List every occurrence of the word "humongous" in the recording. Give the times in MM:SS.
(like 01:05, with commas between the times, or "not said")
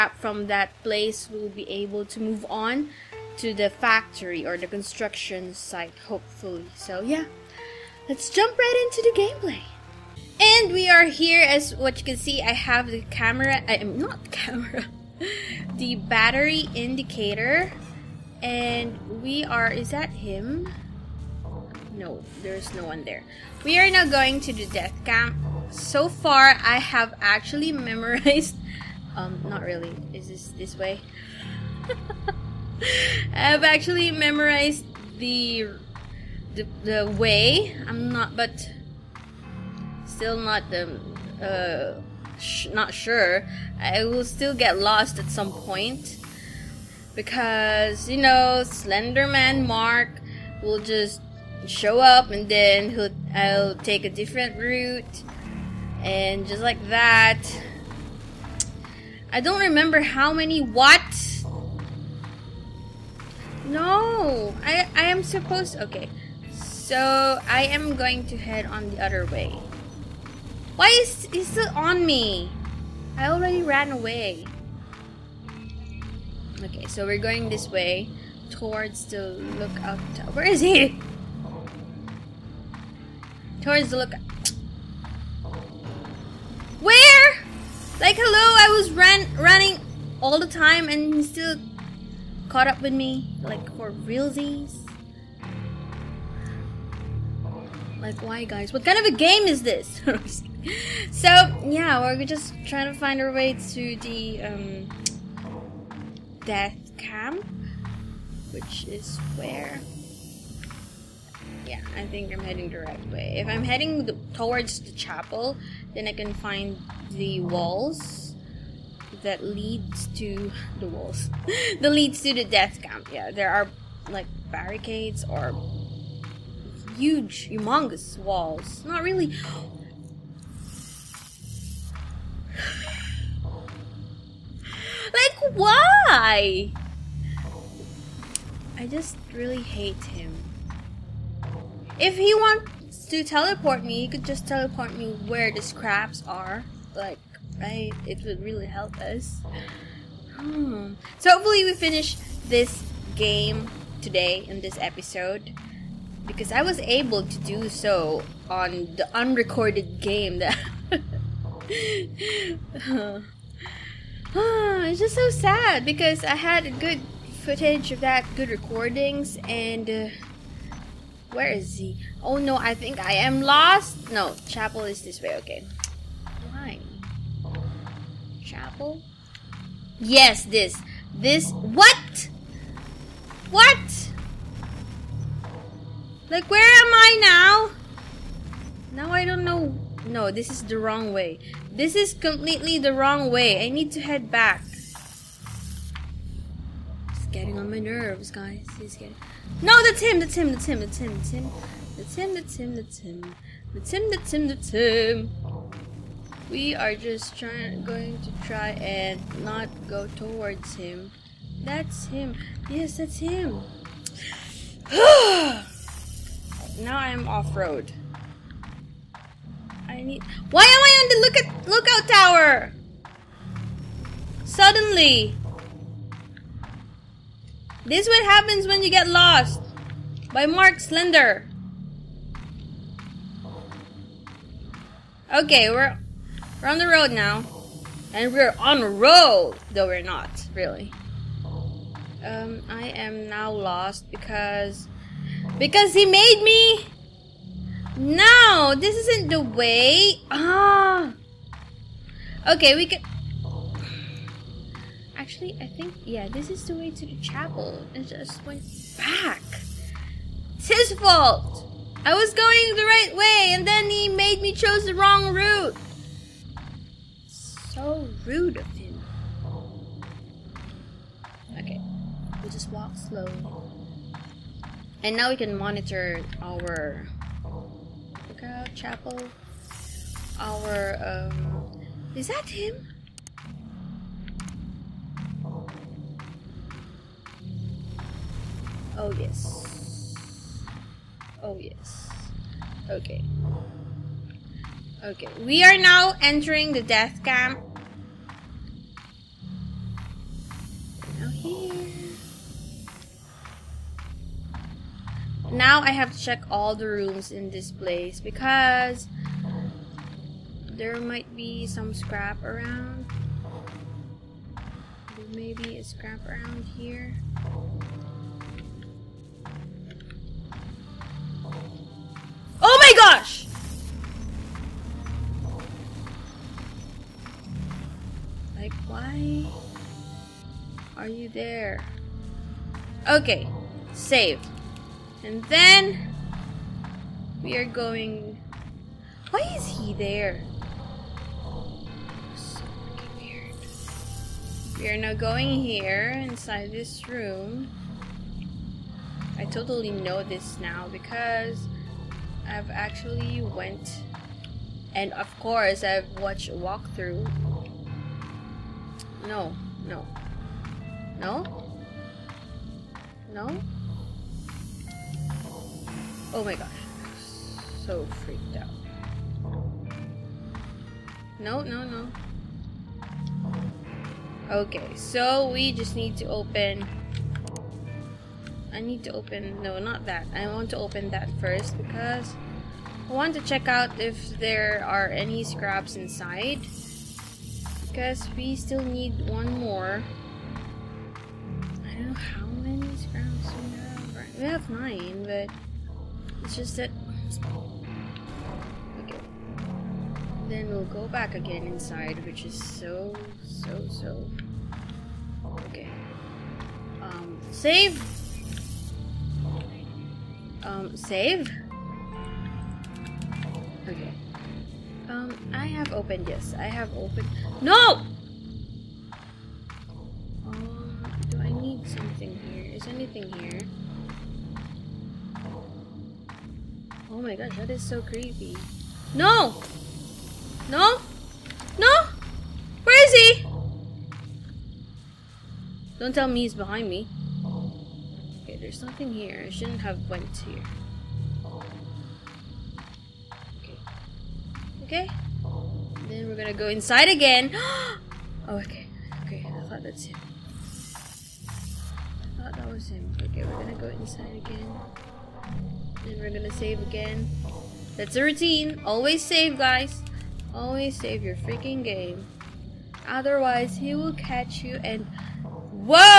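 02:07.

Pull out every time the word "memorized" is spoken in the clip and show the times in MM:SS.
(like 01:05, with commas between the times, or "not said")
00:27, 00:34.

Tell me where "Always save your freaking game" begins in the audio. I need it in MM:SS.
07:40.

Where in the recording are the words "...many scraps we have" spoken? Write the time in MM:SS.
06:32.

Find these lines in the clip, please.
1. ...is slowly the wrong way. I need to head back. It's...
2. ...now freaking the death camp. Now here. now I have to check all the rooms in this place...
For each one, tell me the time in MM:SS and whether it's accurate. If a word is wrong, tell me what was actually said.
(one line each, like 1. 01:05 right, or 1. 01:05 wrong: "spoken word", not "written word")
1. 03:11 wrong: "completely", not "slowly"
2. 04:55 wrong: "entering", not "freaking".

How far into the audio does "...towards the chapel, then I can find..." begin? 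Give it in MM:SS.
01:54.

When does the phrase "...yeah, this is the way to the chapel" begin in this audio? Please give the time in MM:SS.
04:16.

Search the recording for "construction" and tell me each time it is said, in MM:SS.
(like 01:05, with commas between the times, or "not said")
00:04.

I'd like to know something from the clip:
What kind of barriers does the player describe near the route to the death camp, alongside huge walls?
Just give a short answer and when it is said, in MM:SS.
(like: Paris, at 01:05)
barricades, at 02:04.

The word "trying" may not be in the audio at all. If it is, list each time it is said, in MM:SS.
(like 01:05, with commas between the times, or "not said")
01:42, 03:27.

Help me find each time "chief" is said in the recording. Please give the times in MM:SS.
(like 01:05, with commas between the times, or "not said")
not said.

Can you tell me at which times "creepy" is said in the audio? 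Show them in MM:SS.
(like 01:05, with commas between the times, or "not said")
07:08.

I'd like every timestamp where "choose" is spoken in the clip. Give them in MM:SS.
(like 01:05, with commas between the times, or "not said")
04:24.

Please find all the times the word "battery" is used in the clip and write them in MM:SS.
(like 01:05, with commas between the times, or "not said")
00:15.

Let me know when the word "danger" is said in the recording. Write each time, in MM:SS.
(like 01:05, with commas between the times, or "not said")
not said.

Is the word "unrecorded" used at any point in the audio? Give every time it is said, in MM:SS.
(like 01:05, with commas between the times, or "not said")
02:39.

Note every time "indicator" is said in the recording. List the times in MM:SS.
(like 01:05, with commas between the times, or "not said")
00:16.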